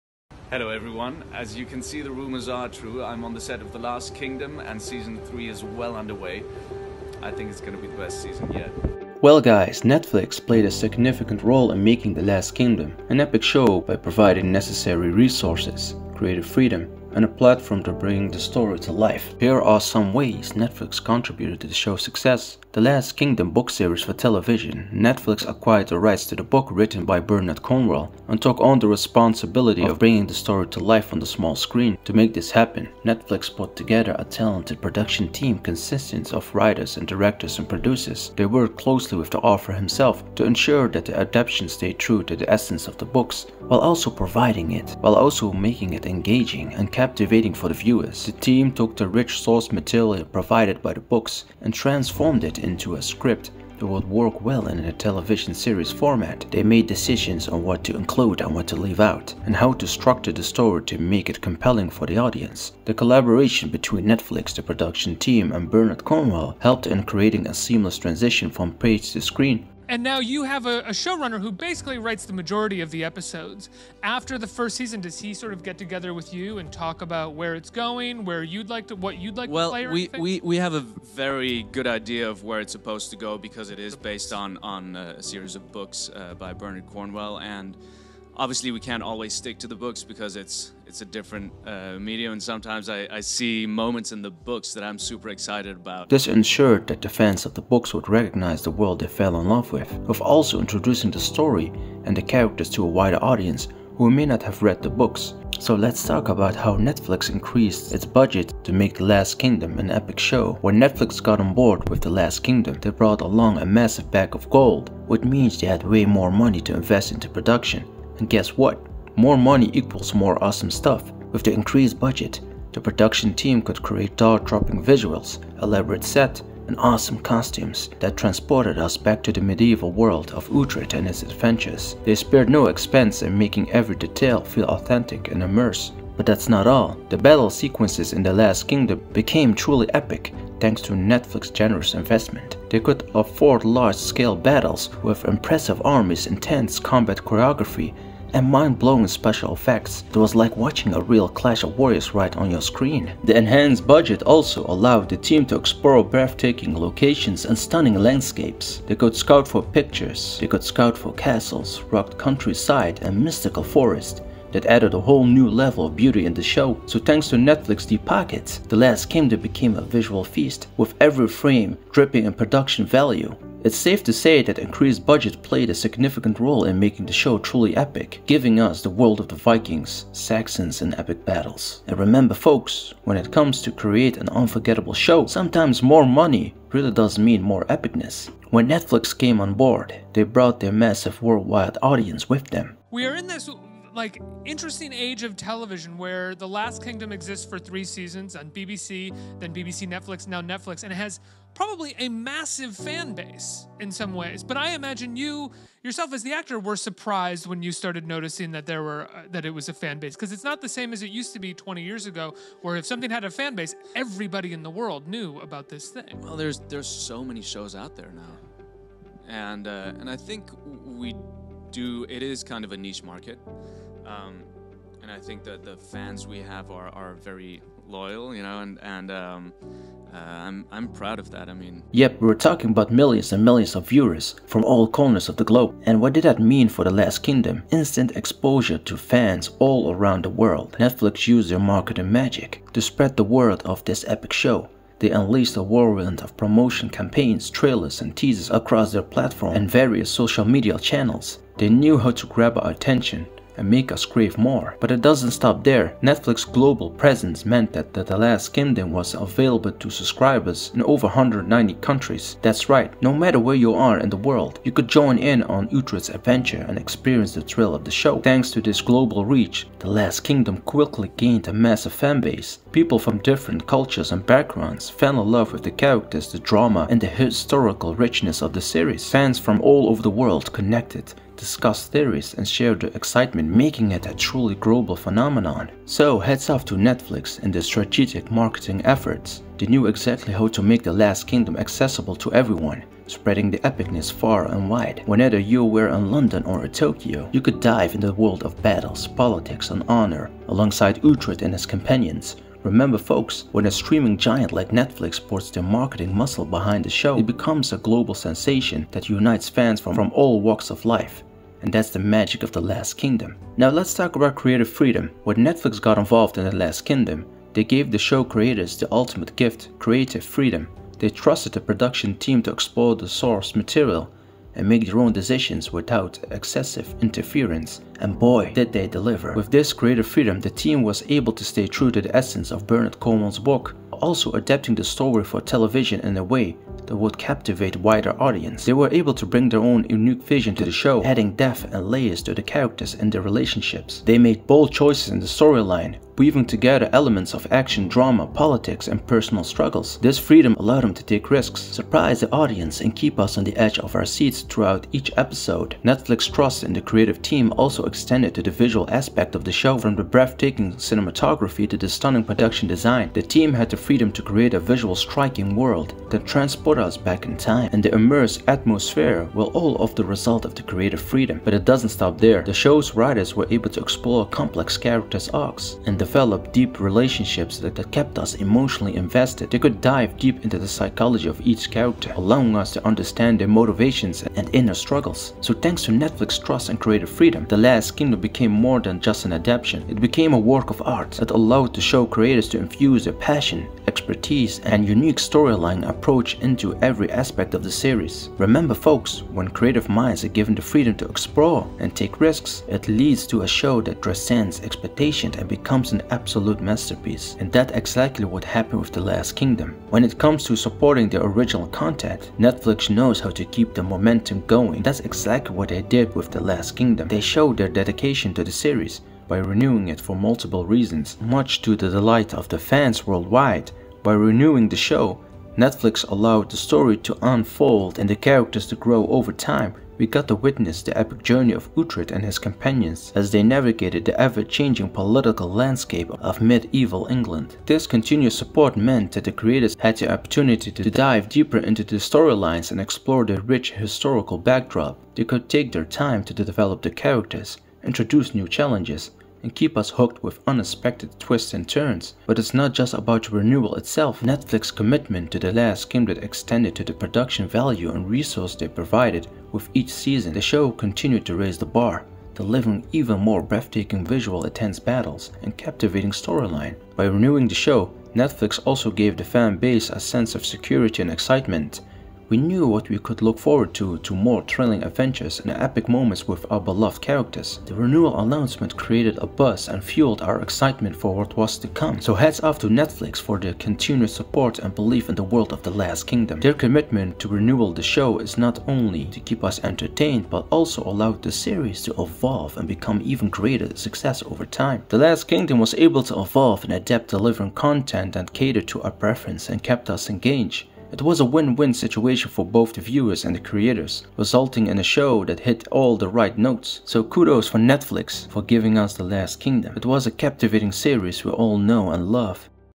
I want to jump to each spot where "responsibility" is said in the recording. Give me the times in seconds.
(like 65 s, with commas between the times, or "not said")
28 s.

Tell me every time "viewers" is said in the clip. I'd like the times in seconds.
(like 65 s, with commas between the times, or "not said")
47 s, 233 s, 502 s.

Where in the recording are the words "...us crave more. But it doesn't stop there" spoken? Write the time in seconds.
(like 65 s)
253 s.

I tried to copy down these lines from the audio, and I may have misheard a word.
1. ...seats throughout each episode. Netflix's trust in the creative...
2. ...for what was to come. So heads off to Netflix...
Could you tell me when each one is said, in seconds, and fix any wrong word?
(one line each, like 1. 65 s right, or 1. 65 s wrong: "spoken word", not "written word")
1. 354 s right
2. 480 s right.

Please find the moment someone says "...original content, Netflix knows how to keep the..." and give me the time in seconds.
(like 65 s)
411 s.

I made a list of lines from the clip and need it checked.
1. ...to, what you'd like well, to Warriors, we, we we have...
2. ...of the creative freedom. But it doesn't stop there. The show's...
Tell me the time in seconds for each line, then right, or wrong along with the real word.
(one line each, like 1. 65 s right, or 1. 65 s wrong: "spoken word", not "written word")
1. 78 s wrong: "Well", not "Warriors"
2. 370 s right.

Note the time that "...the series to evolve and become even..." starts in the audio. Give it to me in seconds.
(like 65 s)
491 s.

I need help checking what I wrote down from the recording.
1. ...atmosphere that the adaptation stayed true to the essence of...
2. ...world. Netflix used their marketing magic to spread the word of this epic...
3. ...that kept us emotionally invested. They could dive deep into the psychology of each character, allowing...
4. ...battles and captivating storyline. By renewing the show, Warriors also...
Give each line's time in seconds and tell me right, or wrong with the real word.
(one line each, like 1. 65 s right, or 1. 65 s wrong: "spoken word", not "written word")
1. 40 s wrong: "ensure", not "atmosphere"
2. 240 s right
3. 377 s right
4. 464 s wrong: "Netflix", not "Warriors".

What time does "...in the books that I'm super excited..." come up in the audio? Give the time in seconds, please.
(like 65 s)
94 s.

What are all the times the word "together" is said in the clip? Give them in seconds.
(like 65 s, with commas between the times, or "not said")
33 s, 75 s, 346 s.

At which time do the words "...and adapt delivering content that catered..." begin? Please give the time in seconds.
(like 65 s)
496 s.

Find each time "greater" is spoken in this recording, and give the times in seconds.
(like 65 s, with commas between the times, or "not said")
329 s, 493 s.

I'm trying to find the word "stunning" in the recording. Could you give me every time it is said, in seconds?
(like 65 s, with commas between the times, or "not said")
157 s, 361 s.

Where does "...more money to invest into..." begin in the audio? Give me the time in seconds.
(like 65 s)
116 s.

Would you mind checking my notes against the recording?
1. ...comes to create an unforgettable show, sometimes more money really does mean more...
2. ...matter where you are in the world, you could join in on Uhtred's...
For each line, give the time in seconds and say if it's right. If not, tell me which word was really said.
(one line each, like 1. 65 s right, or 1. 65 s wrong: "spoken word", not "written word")
1. 183 s right
2. 263 s right.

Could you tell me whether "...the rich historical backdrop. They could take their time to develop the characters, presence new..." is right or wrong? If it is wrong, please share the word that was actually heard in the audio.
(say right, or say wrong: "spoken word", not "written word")
wrong: "introduce", not "presence".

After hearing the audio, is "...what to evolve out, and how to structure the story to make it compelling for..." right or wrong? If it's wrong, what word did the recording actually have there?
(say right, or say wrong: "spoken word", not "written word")
wrong: "leave", not "evolve".